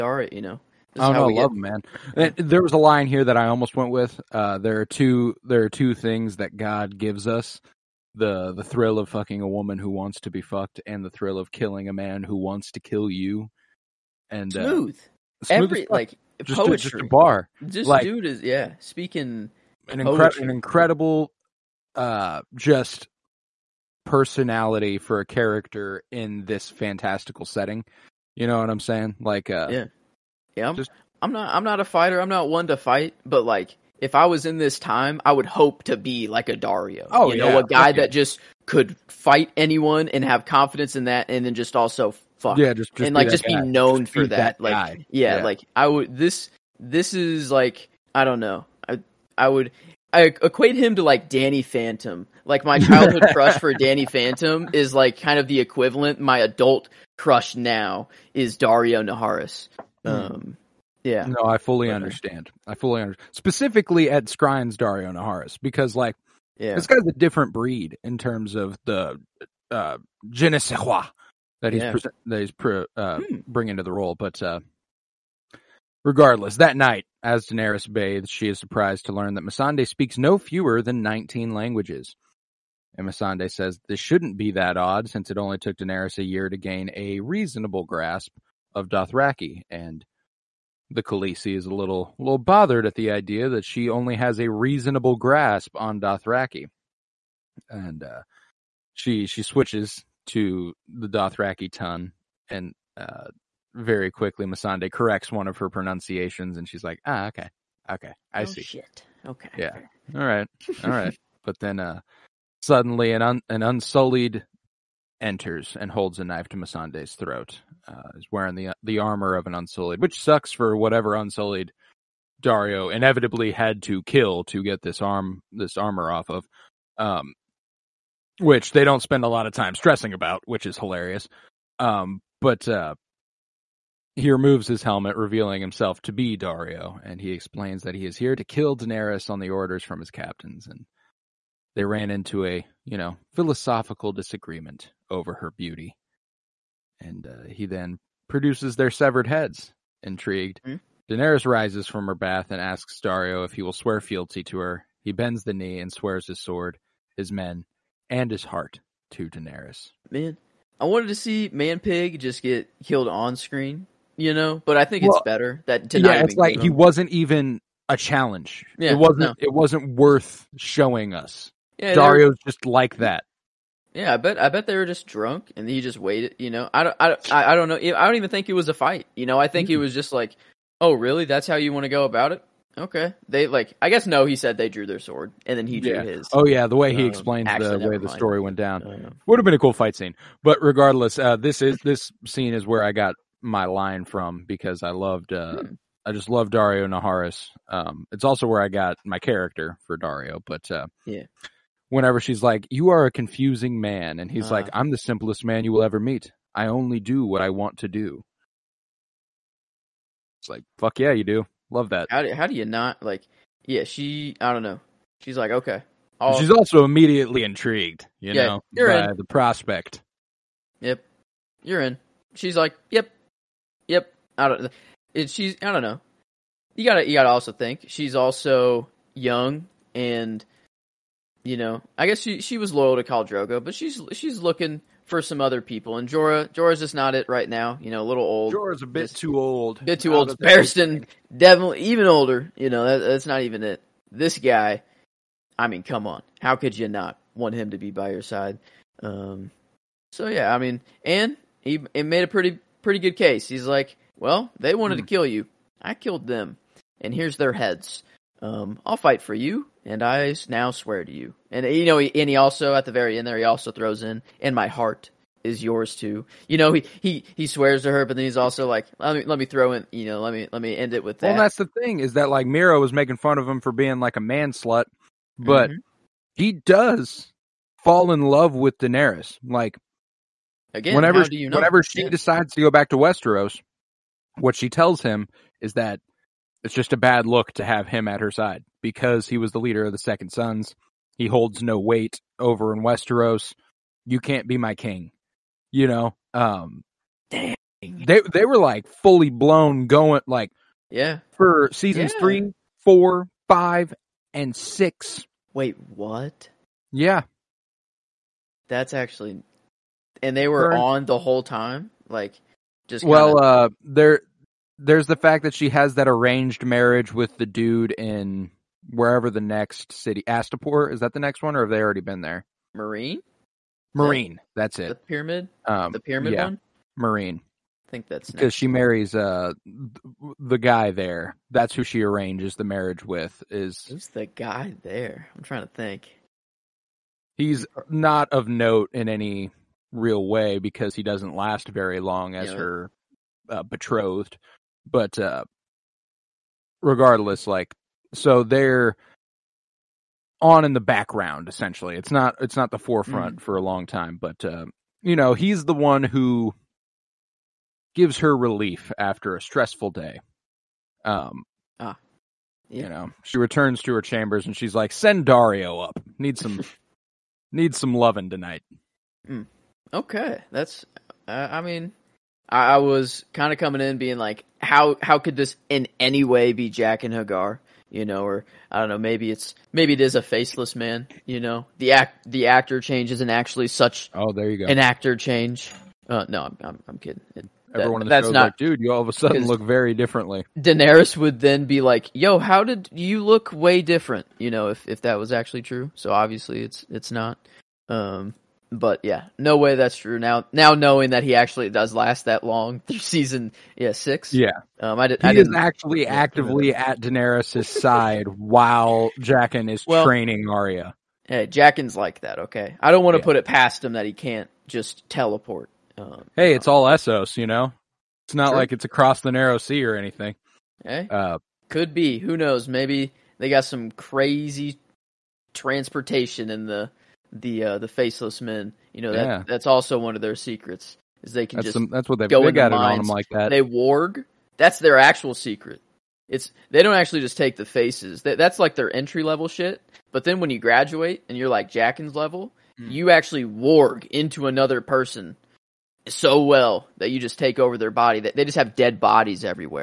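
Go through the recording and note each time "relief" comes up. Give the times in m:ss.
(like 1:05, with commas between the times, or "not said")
5:58.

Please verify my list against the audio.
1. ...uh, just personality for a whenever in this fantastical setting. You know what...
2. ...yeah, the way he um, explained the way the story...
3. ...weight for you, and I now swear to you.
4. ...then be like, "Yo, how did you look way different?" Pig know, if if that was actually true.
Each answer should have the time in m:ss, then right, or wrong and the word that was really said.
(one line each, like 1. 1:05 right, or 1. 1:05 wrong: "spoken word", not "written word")
1. 0:21 wrong: "character", not "whenever"
2. 3:06 right
3. 4:18 wrong: "fight", not "weight"
4. 6:31 wrong: "You", not "Pig".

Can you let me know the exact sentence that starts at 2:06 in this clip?
Um, which they don't spend a lot of time stressing about, which is hilarious.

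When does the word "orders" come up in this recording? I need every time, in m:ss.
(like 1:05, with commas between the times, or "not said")
2:19.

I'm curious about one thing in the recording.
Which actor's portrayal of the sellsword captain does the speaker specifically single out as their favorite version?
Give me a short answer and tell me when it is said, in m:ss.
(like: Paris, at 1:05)
Ed Skrein, at 1:04.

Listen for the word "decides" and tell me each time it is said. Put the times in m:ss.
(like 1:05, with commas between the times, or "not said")
4:42.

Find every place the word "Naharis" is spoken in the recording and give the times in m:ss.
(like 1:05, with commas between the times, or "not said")
0:59, 1:05, 3:16.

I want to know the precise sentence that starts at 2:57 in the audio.
I don't even think it was a fight.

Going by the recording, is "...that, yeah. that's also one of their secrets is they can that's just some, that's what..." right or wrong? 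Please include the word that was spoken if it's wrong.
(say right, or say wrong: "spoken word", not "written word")
right.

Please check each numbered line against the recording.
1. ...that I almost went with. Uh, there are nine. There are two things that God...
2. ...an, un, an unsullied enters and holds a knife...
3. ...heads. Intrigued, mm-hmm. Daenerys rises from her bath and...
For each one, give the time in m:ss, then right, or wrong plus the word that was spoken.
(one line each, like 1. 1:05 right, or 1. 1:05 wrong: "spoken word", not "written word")
1. 0:03 wrong: "two", not "nine"
2. 1:53 right
3. 2:29 right.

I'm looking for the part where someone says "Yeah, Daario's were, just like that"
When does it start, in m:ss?
2:51.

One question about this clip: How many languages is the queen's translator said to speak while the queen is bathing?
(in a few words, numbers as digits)
19.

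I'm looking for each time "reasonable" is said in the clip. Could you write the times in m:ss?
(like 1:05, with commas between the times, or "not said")
1:27, 1:34.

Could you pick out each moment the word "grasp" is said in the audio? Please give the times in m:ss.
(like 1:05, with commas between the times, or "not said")
1:27, 1:35.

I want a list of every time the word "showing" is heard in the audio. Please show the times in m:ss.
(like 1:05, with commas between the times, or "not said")
2:50.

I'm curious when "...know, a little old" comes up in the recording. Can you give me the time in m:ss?
3:57.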